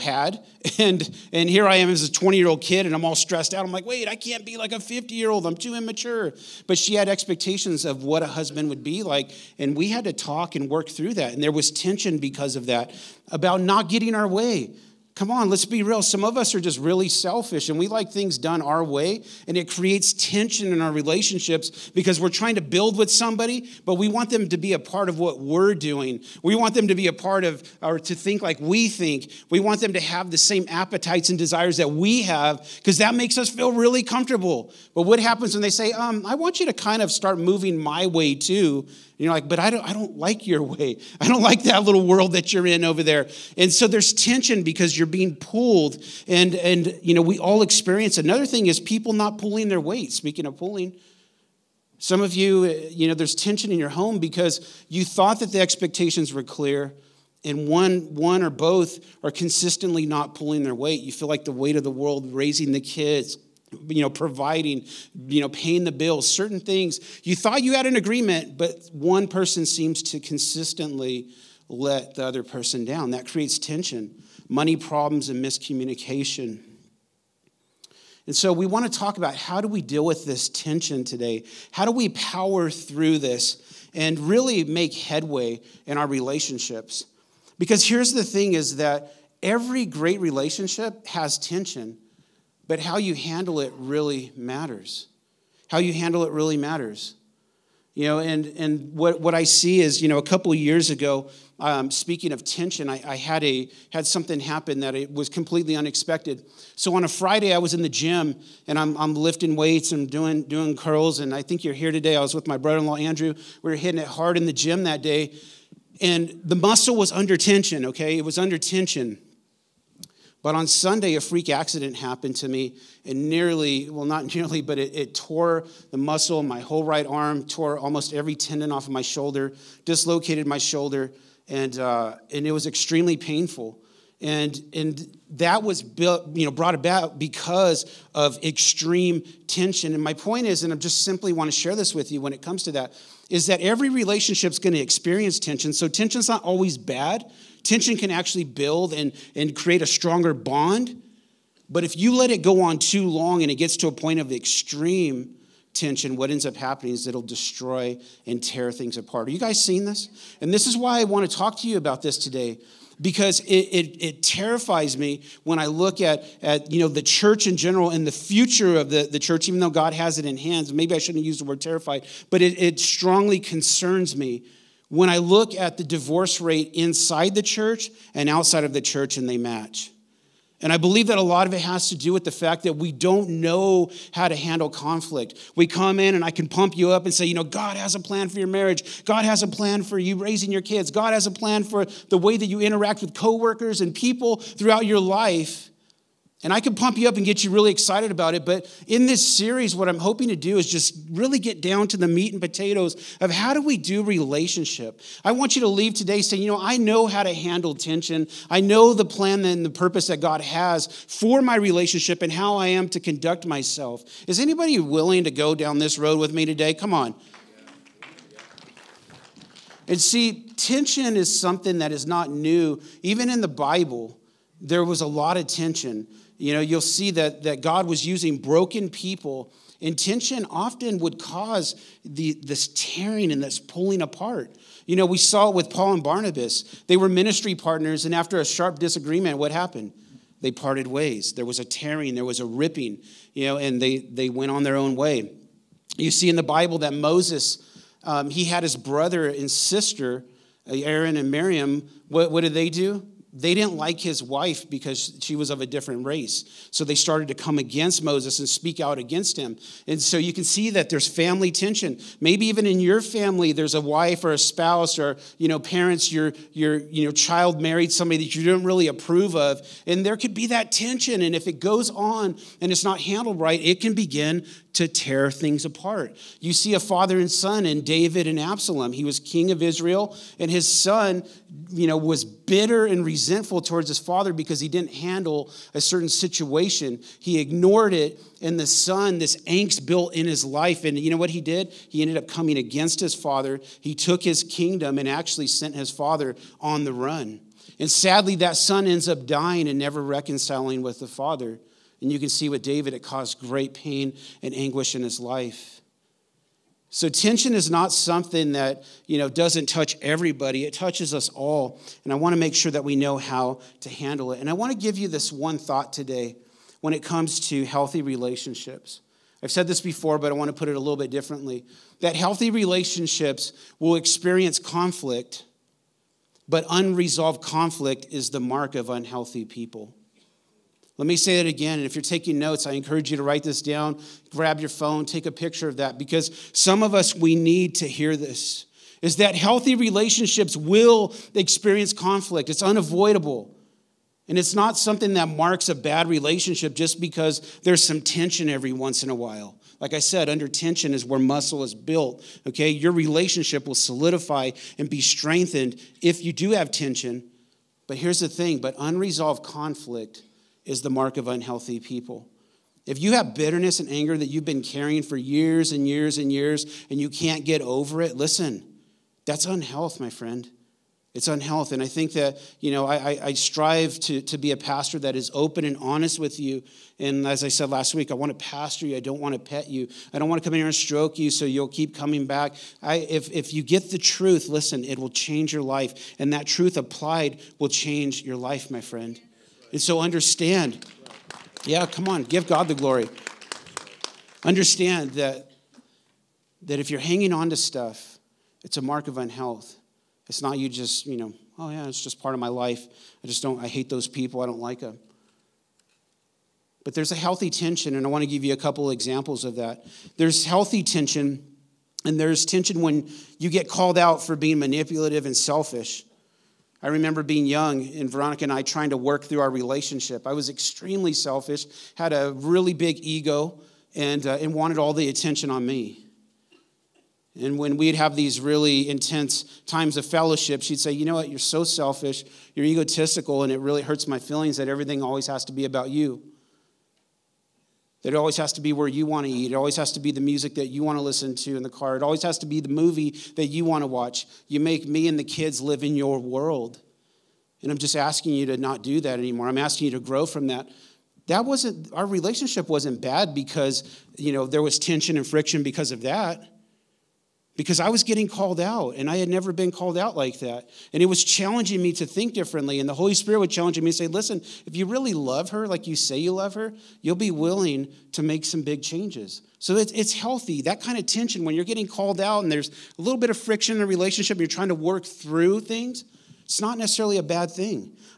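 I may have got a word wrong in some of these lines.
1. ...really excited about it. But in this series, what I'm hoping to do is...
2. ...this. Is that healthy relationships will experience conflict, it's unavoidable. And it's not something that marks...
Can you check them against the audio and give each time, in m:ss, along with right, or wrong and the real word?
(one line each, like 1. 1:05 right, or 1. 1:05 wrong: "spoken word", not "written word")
1. 3:17 right
2. 5:38 right.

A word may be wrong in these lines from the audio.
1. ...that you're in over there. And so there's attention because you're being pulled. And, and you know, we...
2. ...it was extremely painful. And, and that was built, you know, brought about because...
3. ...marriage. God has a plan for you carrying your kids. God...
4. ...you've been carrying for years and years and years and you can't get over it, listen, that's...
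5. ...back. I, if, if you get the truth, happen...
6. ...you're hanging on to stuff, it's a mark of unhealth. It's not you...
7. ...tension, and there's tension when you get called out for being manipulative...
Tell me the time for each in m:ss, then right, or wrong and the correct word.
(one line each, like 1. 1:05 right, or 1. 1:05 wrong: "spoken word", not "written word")
1. 0:42 wrong: "tension", not "attention"
2. 2:12 right
3. 3:08 wrong: "raising", not "carrying"
4. 6:04 right
5. 6:22 wrong: "listen", not "happen"
6. 6:36 right
7. 6:50 right.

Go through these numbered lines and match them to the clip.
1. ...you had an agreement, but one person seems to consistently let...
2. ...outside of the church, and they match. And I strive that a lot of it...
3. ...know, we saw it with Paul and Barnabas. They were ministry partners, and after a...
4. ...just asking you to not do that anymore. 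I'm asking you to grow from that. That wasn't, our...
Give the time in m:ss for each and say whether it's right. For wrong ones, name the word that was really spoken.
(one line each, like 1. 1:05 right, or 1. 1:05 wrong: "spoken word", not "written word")
1. 1:07 right
2. 2:58 wrong: "believe", not "strive"
3. 3:54 right
4. 7:27 right.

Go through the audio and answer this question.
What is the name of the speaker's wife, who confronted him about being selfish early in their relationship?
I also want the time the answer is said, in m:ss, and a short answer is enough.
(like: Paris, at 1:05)
Veronica, at 6:58.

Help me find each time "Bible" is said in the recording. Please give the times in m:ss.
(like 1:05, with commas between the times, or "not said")
3:43, 4:06.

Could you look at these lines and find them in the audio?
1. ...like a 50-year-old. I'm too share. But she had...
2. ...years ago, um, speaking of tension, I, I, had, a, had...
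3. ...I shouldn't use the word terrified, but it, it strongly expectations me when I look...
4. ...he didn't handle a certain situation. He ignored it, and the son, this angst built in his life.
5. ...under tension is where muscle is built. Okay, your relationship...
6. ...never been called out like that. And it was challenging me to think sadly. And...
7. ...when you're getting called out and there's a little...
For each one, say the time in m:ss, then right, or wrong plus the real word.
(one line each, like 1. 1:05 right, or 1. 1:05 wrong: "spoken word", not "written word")
1. 0:04 wrong: "immature", not "share"
2. 1:40 right
3. 2:50 wrong: "concerns", not "expectations"
4. 4:44 right
5. 5:50 right
6. 7:39 wrong: "differently", not "sadly"
7. 7:51 right.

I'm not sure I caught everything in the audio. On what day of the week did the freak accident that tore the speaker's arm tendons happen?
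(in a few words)
Sunday.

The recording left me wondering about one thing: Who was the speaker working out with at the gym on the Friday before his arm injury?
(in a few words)
Andrew.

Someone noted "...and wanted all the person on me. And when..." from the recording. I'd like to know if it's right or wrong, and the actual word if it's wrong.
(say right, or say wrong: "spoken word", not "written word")
wrong: "attention", not "person".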